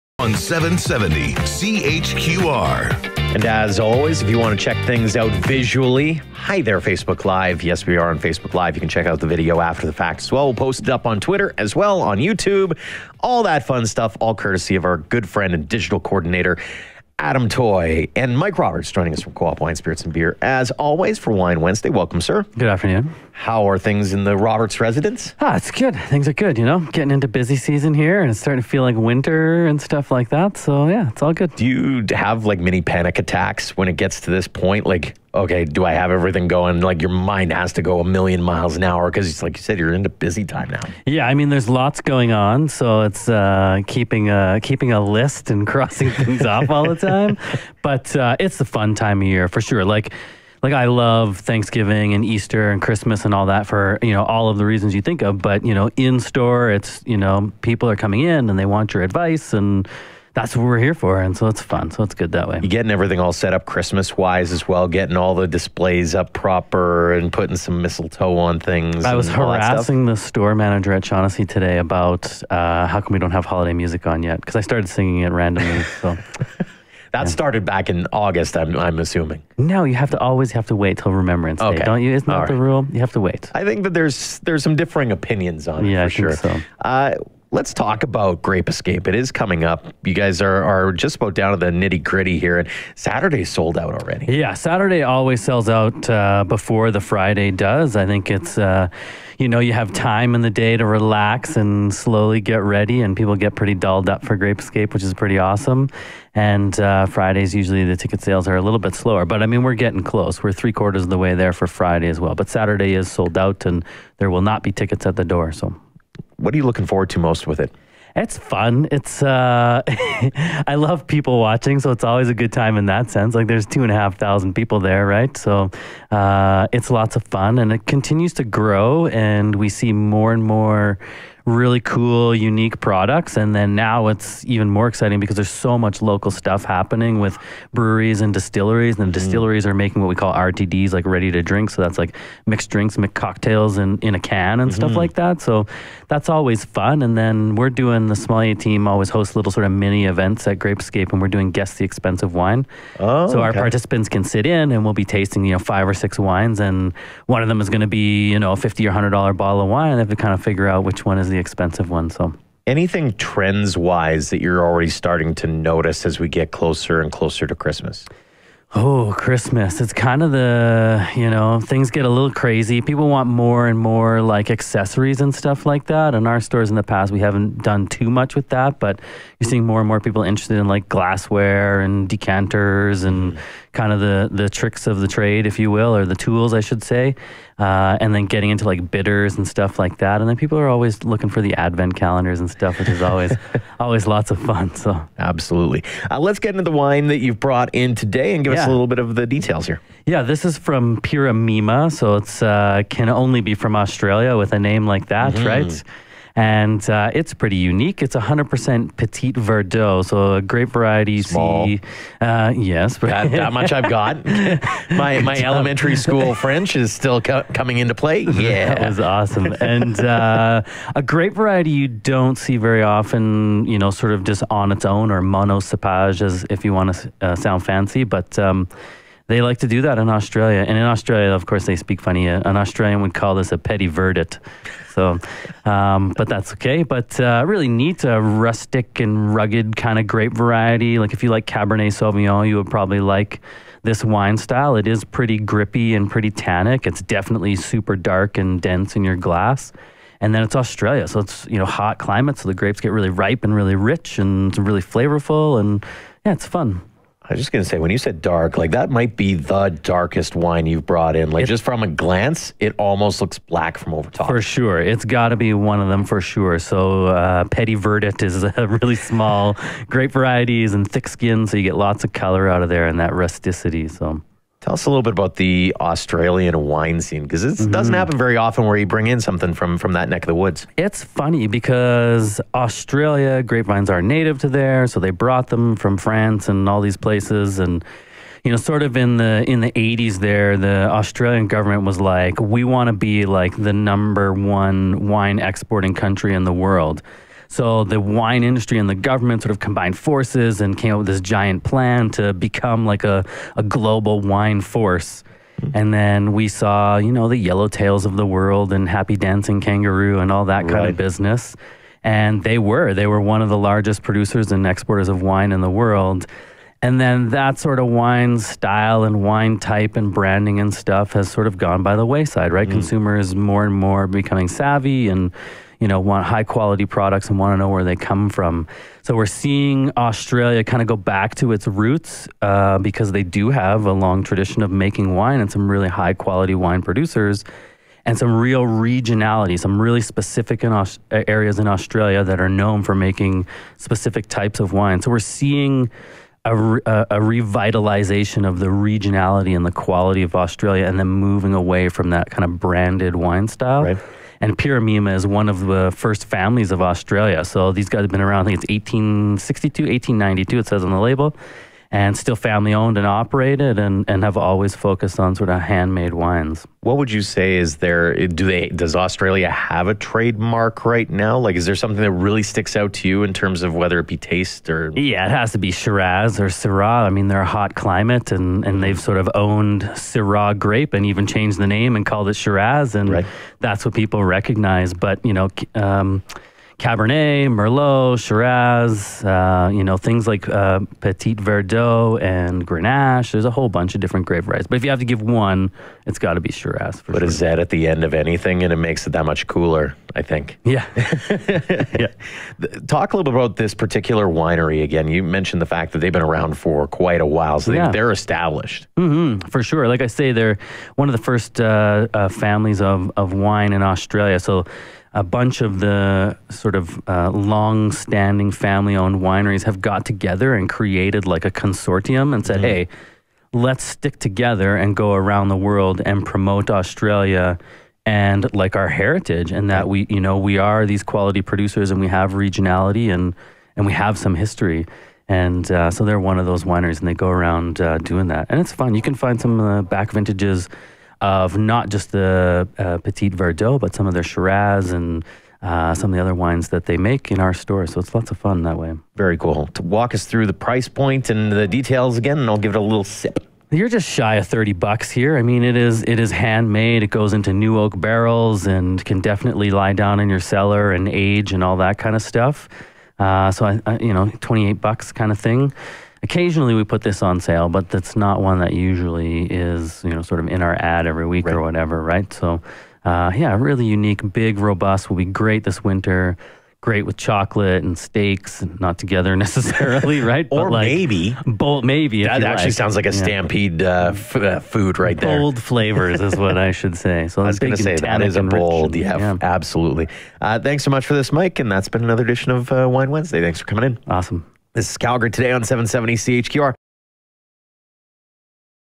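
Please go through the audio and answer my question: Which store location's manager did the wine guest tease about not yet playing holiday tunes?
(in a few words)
Shaughnessy.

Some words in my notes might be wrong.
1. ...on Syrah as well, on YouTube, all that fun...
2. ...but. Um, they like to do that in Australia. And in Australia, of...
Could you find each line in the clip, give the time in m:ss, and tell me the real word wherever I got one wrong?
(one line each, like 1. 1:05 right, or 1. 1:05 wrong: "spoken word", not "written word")
1. 0:11 wrong: "Twitter", not "Syrah"
2. 3:48 right.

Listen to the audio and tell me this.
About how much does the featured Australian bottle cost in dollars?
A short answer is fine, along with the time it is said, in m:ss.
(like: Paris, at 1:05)
$28, at 7:44.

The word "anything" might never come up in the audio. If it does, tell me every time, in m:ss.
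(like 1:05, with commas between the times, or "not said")
2:42, 6:38.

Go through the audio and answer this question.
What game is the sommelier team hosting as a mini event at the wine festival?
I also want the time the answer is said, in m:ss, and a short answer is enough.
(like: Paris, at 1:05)
Guess the Expensive Wine, at 2:31.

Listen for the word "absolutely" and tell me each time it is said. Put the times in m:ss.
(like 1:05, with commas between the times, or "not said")
3:15, 8:09.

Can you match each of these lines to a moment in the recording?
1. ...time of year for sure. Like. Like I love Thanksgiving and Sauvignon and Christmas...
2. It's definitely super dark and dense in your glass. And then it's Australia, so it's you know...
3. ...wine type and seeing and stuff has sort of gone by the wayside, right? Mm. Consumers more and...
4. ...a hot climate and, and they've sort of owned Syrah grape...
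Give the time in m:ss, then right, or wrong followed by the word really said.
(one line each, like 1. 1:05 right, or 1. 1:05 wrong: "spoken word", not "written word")
1. 0:48 wrong: "Easter", not "Sauvignon"
2. 4:06 right
3. 5:19 wrong: "branding", not "seeing"
4. 6:17 right.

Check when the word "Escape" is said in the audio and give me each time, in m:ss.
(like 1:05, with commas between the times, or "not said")
1:28, 1:44, 2:30.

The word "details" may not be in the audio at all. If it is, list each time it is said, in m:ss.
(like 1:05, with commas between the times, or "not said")
3:19, 7:31.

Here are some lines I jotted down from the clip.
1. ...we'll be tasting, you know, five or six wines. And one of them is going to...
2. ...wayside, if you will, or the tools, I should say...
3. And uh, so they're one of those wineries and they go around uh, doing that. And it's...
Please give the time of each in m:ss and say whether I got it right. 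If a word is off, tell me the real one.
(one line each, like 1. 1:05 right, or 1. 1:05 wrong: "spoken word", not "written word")
1. 2:34 right
2. 3:05 wrong: "trade", not "wayside"
3. 7:15 right.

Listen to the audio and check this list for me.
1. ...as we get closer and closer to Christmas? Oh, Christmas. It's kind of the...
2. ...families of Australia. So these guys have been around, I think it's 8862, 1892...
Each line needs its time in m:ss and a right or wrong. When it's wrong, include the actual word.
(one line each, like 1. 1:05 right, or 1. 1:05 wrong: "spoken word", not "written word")
1. 2:46 right
2. 5:56 wrong: "1862", not "8862".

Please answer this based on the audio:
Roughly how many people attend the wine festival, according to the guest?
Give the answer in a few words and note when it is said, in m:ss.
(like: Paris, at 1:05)
2,500, at 2:03.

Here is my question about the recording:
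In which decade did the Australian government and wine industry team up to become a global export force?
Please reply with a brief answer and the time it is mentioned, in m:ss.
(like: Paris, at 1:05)
1980s, at 4:49.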